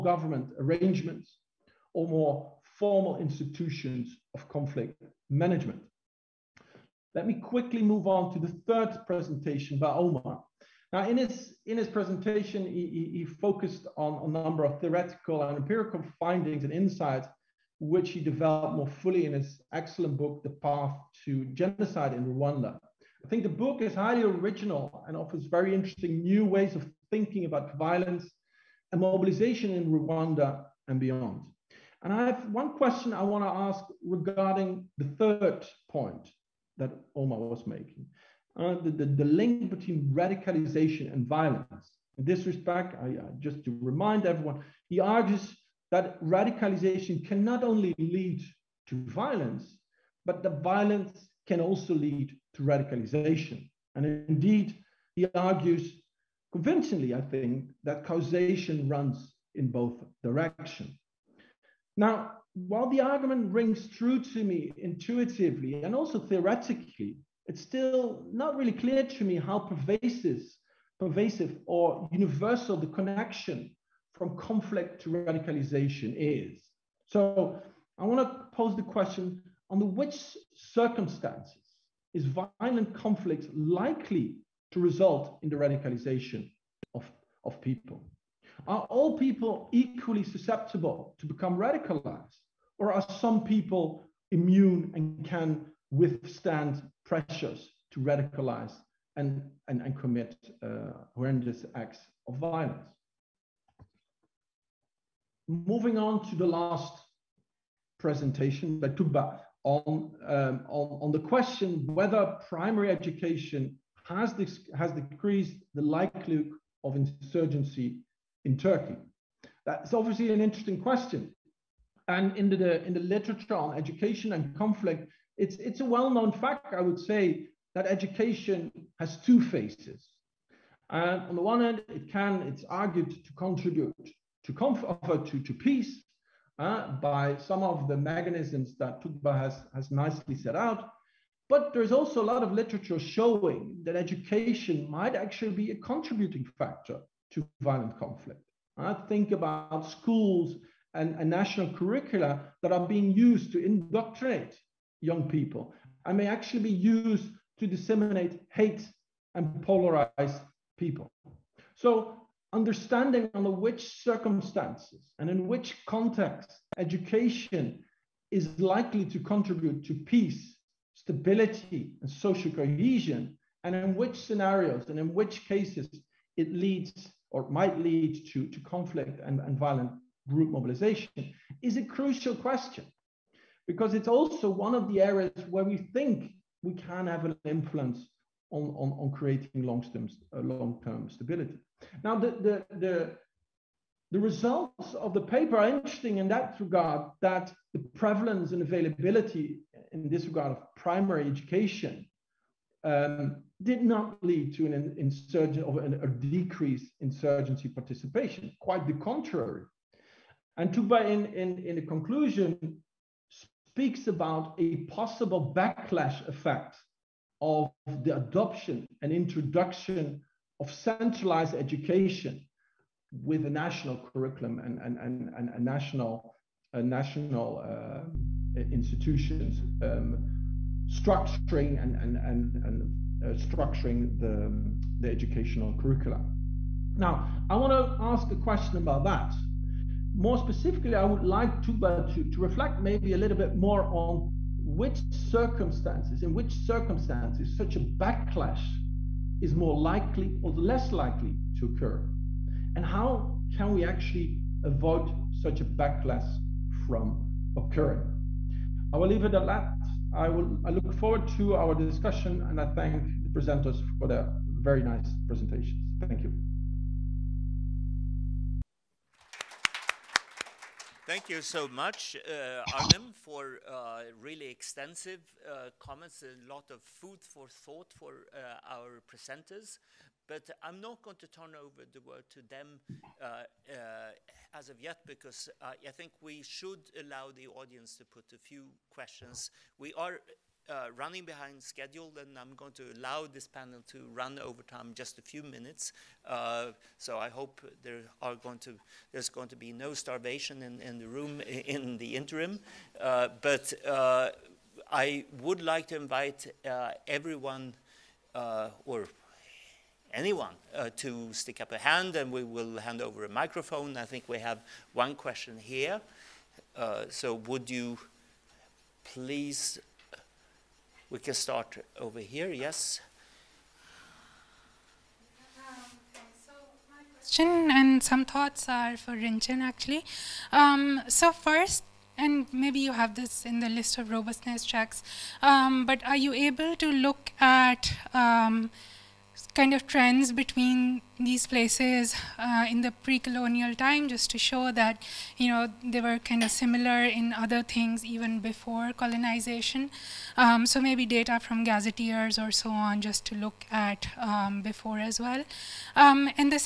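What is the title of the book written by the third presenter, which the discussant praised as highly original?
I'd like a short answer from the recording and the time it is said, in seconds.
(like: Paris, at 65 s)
The Path to Genocide in Rwanda, at 20 s.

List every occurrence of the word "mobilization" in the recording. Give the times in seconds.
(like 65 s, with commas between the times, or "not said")
29 s, 180 s.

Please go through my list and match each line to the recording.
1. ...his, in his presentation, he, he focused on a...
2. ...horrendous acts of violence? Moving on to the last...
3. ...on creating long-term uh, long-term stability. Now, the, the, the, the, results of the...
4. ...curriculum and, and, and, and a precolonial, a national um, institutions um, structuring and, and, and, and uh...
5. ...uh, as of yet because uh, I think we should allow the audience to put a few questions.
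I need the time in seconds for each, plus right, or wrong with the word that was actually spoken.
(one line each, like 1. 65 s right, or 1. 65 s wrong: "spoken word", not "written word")
1. 11 s right
2. 101 s right
3. 188 s right
4. 223 s wrong: "national", not "precolonial"
5. 283 s right.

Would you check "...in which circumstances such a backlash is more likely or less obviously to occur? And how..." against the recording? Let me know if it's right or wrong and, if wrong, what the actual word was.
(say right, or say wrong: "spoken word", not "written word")
wrong: "likely", not "obviously".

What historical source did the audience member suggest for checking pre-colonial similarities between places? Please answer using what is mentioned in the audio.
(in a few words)
gazetteers.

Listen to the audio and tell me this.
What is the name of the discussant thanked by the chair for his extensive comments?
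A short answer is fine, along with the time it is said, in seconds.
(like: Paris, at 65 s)
Arnim, at 272 s.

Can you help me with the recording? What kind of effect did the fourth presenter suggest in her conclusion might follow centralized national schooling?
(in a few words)
backlash effect.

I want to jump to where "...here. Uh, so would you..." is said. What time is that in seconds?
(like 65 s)
315 s.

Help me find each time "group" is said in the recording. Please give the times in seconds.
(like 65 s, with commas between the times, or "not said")
180 s.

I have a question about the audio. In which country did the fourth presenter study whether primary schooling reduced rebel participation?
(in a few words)
Turkey.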